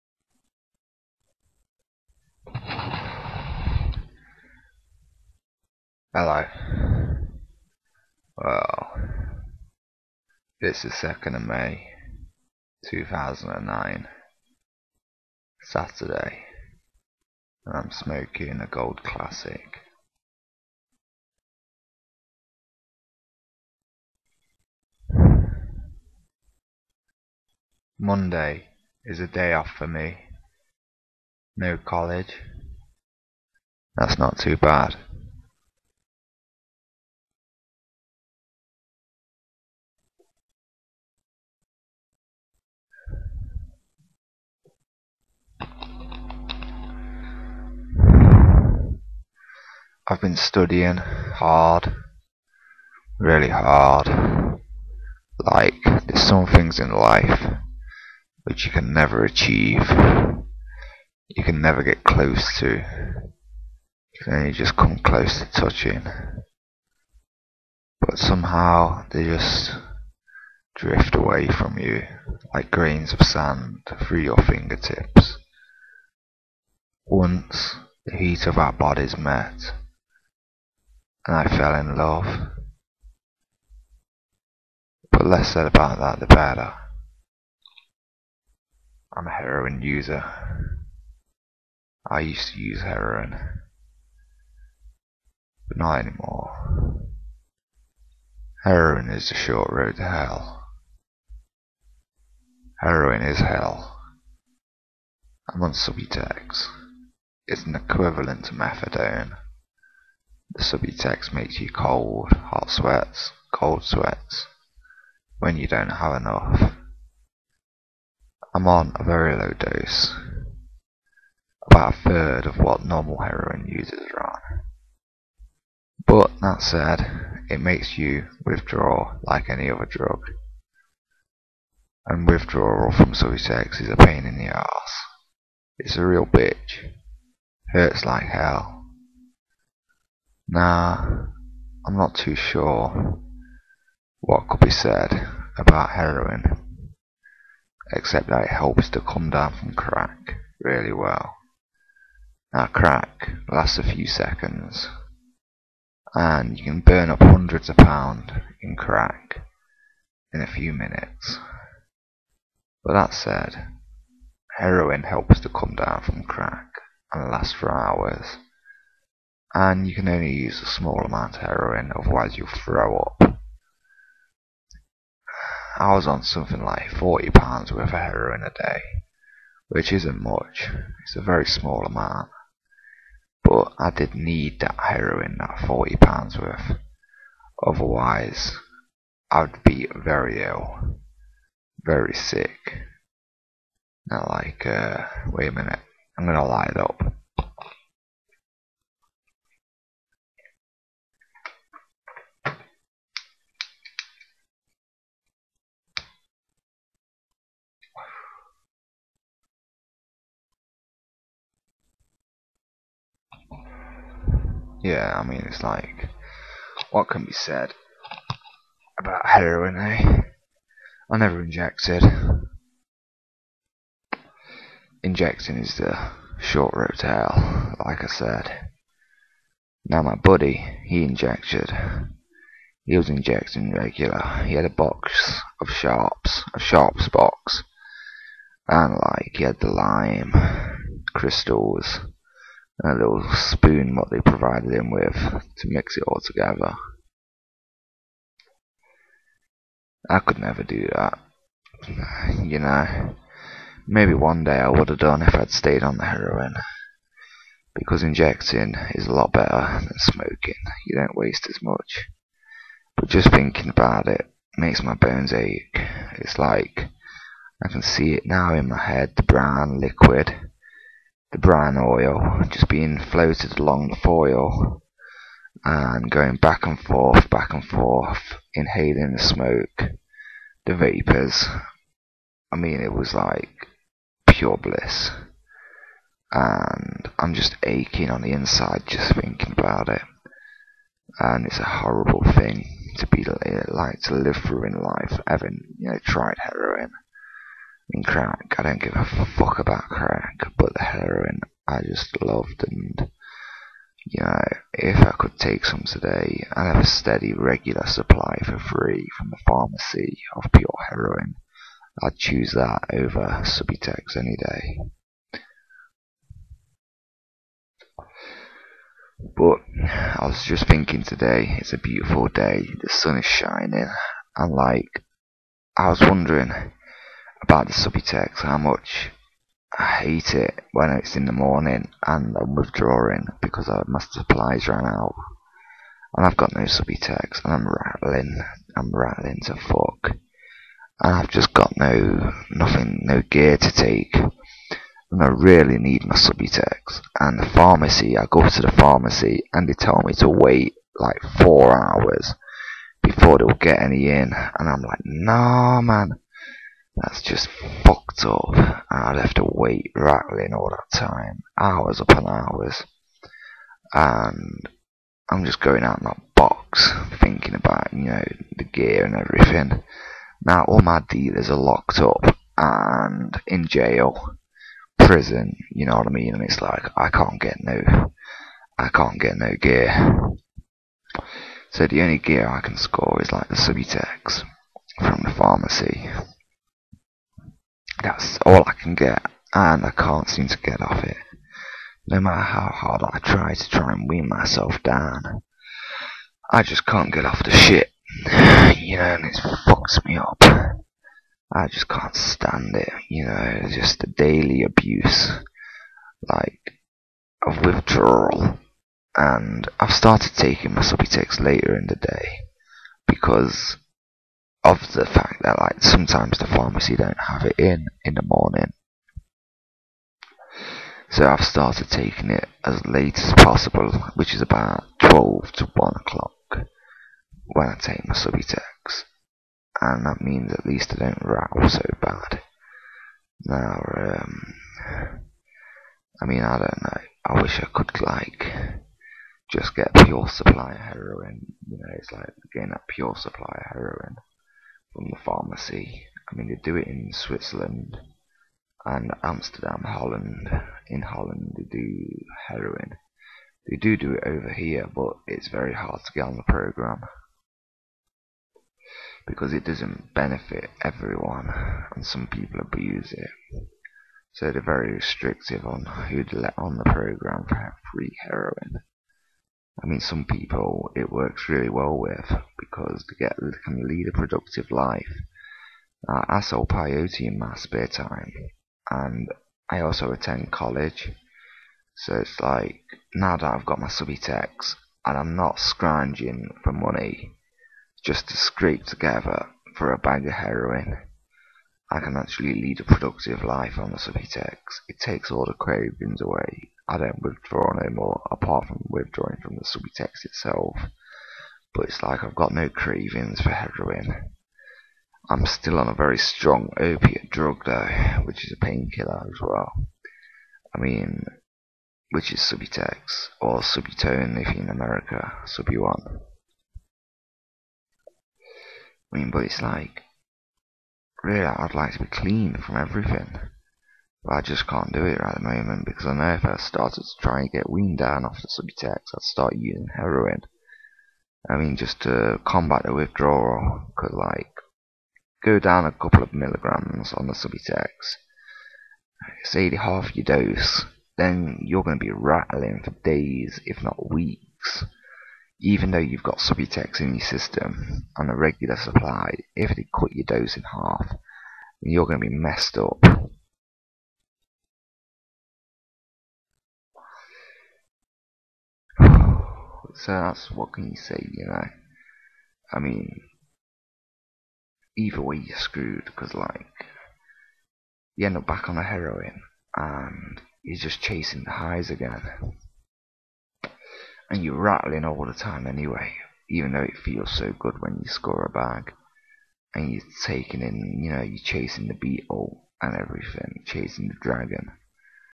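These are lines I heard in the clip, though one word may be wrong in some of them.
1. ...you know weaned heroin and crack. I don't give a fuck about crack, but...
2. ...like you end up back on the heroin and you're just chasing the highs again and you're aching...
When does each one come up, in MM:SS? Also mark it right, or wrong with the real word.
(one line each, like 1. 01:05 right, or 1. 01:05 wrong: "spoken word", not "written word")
1. 04:55 wrong: "tried", not "weaned"
2. 09:26 wrong: "rattling", not "aching".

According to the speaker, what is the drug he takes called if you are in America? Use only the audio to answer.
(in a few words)
Suboxone.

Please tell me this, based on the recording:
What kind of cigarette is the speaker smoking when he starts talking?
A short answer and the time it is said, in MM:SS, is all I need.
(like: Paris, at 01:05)
Gold Classic, at 00:18.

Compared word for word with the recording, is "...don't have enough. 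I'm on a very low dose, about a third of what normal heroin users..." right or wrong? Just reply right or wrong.
right.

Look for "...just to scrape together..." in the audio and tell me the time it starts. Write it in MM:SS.
08:08.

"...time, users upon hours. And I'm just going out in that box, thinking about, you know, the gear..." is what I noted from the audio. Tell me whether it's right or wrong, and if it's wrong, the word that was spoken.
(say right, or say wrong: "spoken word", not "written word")
wrong: "hours", not "users".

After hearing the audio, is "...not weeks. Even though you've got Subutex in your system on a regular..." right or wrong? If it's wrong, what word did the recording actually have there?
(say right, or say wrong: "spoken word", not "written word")
right.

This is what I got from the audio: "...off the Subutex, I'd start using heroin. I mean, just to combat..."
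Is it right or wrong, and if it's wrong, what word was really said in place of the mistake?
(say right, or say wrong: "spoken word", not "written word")
right.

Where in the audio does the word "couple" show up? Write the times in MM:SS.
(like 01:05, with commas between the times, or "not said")
08:55.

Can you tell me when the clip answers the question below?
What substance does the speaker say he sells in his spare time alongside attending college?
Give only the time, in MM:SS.
07:56.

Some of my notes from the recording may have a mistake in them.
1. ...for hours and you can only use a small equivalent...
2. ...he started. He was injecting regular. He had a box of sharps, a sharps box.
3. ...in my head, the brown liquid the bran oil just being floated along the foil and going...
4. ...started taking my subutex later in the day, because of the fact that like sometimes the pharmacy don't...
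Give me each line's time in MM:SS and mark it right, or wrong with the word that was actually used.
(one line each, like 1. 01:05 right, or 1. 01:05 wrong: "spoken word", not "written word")
1. 02:47 wrong: "amount", not "equivalent"
2. 03:50 wrong: "injected", not "started"
3. 04:28 right
4. 06:49 right.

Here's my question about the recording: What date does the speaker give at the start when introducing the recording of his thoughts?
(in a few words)
2 May 2009.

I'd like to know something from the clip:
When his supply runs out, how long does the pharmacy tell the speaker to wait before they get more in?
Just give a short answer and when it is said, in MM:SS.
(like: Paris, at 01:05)
4 hours, at 05:51.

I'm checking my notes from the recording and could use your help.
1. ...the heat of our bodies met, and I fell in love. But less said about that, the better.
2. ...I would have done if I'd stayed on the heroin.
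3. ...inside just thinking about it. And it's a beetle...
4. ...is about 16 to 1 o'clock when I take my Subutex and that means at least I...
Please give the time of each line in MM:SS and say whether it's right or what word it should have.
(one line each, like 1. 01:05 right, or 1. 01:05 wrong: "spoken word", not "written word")
1. 01:18 right
2. 04:14 right
3. 04:48 wrong: "horrible", not "beetle"
4. 07:04 wrong: "12", not "16".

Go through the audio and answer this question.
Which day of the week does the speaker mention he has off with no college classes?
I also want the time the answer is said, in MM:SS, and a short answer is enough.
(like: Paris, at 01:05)
Monday, at 00:27.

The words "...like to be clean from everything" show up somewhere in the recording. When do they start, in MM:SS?
08:41.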